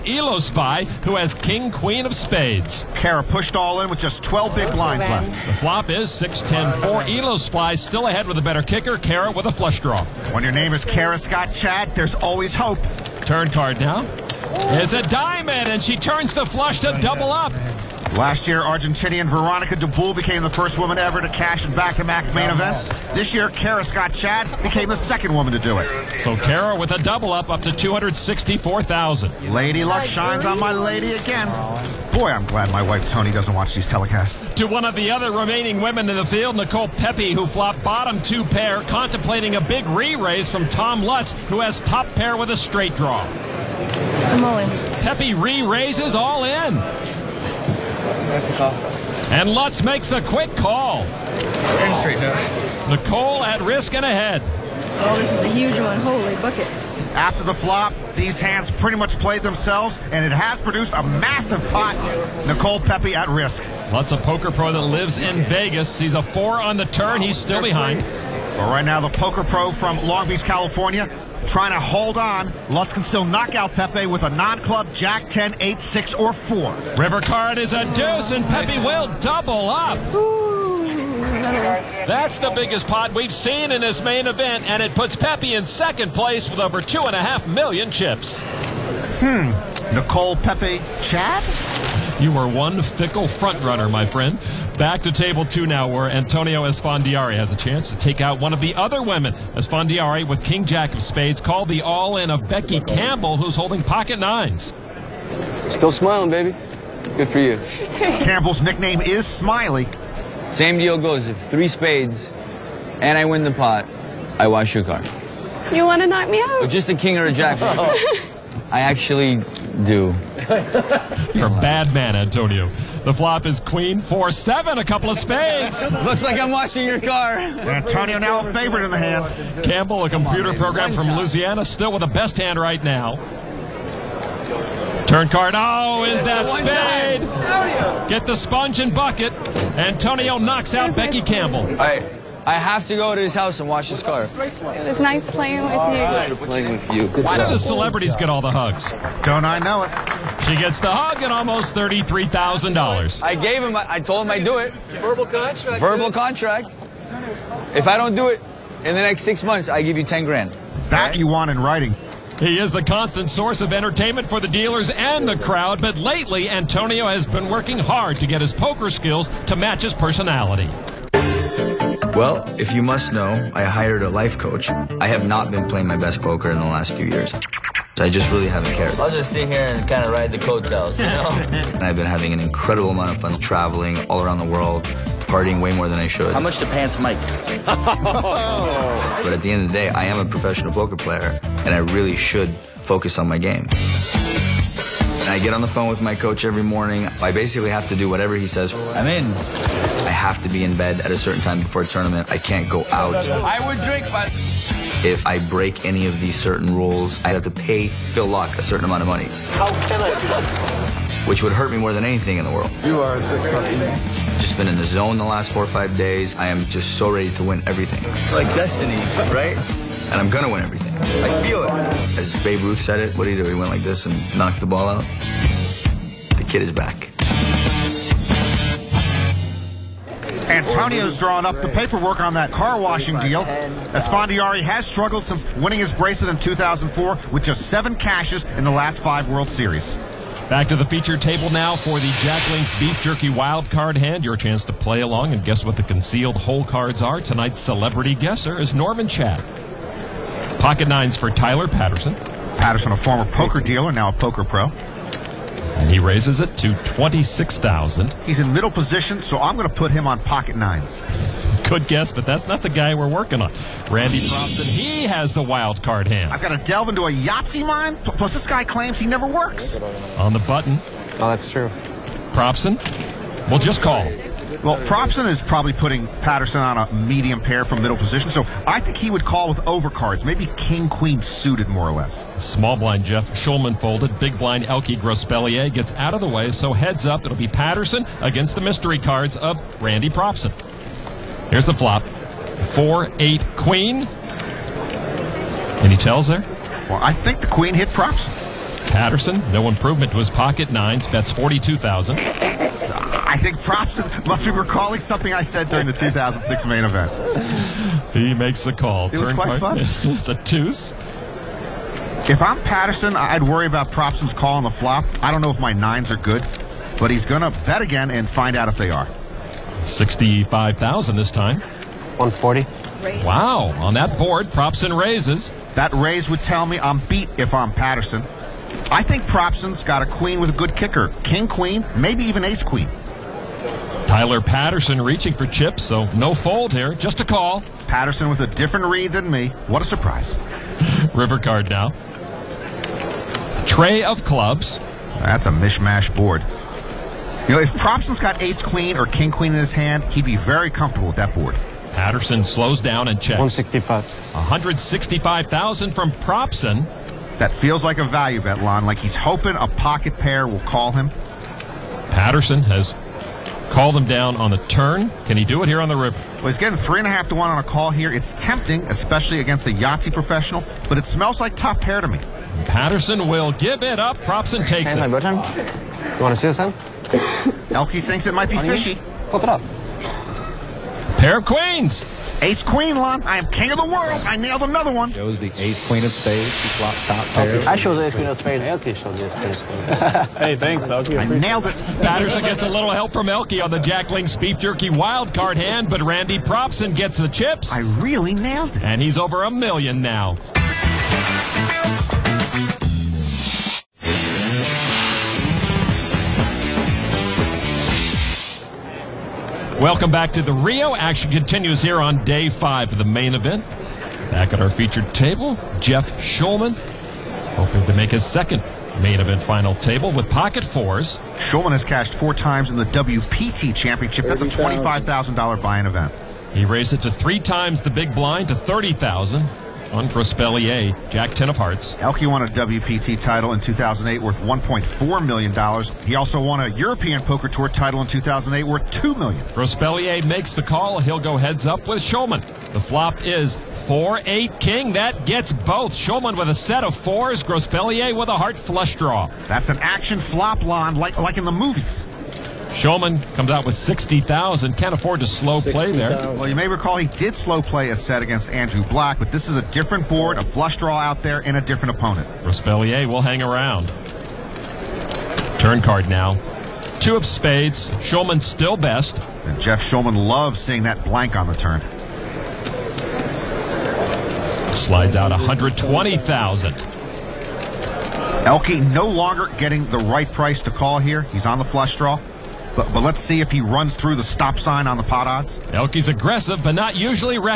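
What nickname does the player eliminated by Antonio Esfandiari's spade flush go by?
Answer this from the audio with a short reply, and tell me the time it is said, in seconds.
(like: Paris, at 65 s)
Smiley, at 109 s.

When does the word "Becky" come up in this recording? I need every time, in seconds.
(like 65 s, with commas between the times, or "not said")
102 s, 140 s.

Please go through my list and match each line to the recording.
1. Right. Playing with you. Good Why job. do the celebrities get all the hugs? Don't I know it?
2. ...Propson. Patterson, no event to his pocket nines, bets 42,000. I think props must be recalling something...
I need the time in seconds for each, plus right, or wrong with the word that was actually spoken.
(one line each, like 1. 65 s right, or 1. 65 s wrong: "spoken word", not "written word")
1. 145 s right
2. 297 s wrong: "improvement", not "event".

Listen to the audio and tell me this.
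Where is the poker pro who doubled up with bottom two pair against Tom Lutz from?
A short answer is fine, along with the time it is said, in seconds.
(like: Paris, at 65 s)
Long Beach, California, at 70 s.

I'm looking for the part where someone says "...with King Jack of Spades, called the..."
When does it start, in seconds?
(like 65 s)
100 s.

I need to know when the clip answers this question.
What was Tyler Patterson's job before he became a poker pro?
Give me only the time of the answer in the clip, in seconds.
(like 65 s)
253 s.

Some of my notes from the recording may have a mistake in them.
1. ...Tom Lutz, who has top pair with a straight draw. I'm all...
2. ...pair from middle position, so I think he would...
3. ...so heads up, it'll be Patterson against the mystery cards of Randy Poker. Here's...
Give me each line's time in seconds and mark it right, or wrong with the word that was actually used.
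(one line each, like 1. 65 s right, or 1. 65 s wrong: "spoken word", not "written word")
1. 40 s right
2. 277 s right
3. 286 s wrong: "Propson", not "Poker".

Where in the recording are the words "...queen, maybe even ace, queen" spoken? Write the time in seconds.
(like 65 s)
331 s.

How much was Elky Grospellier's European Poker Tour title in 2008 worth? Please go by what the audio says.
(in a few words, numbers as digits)
$2 million.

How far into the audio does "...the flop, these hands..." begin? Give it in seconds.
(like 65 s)
57 s.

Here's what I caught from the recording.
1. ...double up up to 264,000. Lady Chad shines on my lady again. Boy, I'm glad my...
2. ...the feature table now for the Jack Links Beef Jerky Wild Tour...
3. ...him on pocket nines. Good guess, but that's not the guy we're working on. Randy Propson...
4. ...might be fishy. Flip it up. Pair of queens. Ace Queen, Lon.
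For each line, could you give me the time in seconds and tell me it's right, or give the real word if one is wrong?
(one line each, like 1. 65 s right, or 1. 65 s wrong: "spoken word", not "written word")
1. 27 s wrong: "Luck", not "Chad"
2. 240 s wrong: "Card", not "Tour"
3. 259 s right
4. 378 s right.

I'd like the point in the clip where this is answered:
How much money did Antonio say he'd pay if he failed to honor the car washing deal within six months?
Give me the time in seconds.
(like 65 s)
160 s.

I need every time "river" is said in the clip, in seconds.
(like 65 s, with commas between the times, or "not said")
76 s, 341 s, 365 s.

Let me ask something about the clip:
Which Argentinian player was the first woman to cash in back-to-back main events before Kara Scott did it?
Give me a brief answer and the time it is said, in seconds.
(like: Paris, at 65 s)
Veronica Dabul, at 19 s.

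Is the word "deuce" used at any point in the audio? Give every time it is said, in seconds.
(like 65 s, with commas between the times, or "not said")
77 s, 310 s.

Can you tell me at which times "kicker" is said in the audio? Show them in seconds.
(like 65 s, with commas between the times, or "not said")
8 s, 330 s.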